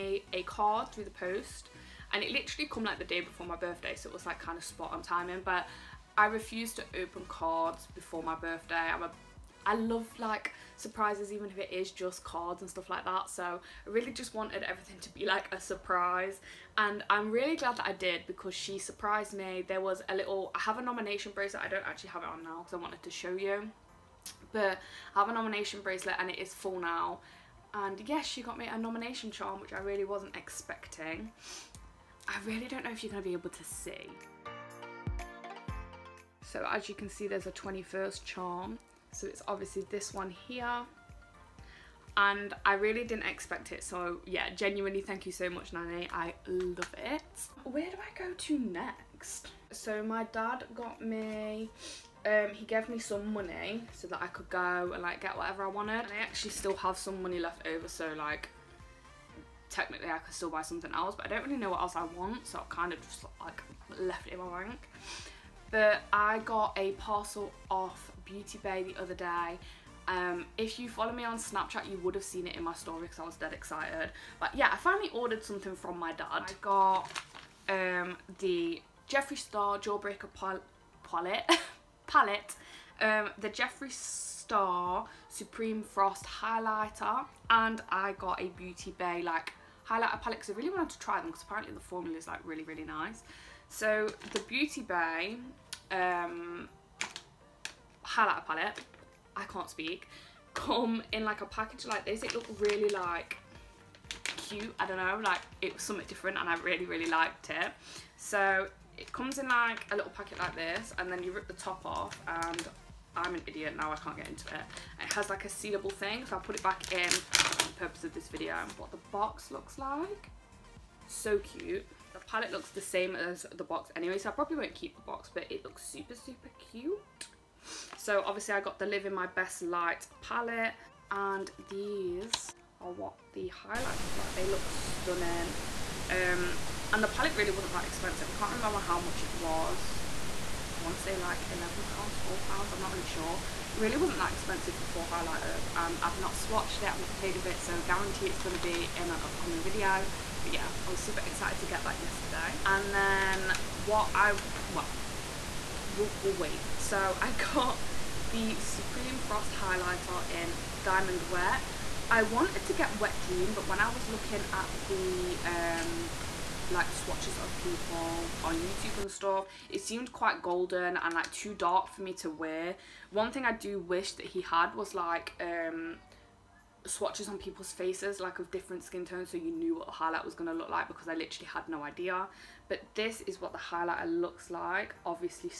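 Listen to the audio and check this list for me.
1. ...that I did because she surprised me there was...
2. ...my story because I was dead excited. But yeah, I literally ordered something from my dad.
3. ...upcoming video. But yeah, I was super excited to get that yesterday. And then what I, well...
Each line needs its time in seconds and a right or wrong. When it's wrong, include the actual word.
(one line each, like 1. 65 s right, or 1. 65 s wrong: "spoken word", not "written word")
1. 17 s right
2. 72 s wrong: "finally", not "literally"
3. 149 s right.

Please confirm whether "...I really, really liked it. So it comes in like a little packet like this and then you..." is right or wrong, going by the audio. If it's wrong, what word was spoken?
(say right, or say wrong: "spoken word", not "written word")
right.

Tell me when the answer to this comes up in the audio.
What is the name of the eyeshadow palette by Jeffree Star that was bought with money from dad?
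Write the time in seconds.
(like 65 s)
79 s.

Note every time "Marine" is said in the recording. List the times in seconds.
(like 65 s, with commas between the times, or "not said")
not said.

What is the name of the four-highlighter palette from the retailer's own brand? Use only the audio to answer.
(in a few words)
Live in My Best Light.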